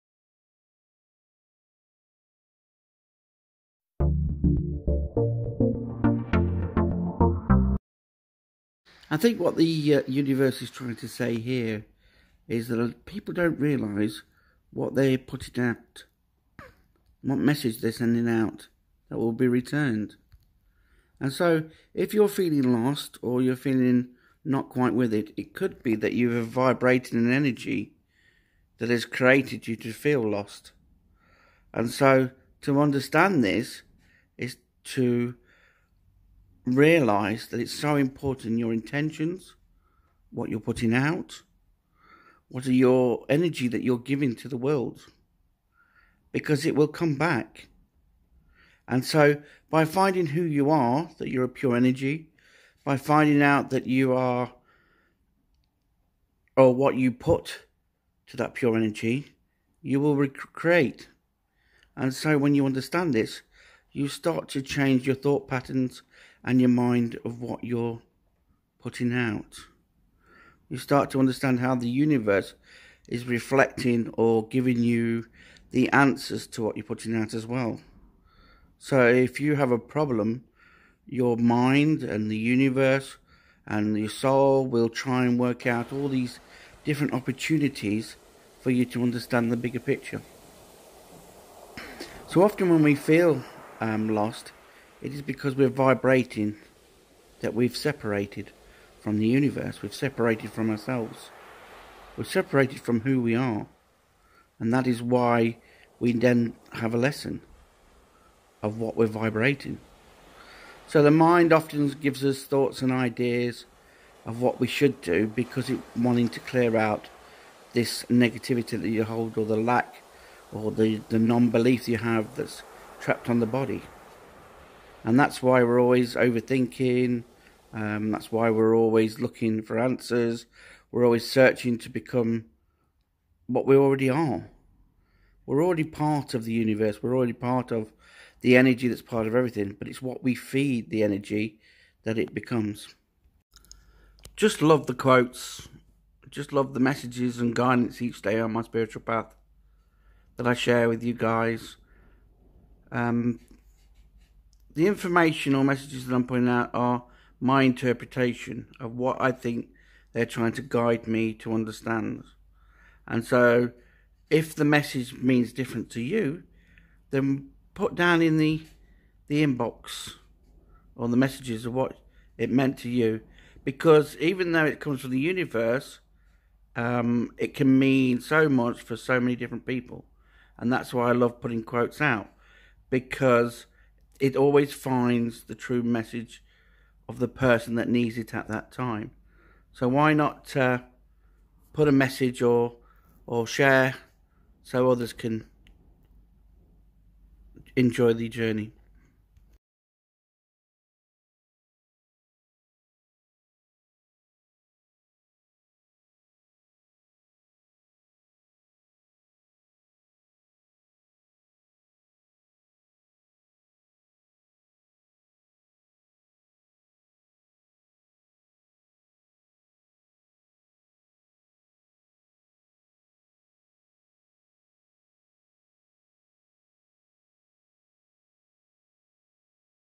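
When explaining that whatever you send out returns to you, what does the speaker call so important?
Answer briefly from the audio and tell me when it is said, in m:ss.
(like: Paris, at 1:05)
intentions, at 0:38.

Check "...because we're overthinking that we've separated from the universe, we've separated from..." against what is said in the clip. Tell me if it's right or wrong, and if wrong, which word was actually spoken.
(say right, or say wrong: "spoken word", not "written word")
wrong: "vibrating", not "overthinking".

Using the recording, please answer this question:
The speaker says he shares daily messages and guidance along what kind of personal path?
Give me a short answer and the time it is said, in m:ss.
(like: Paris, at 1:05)
spiritual path, at 2:28.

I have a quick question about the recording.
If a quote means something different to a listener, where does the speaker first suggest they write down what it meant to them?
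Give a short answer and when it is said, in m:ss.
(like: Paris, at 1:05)
the inbox, at 2:49.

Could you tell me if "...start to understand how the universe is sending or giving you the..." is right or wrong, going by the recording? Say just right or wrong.
wrong.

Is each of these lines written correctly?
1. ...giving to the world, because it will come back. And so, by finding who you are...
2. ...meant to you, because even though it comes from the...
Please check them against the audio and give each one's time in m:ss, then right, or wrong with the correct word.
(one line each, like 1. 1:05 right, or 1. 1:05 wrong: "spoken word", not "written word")
1. 0:43 right
2. 2:52 right.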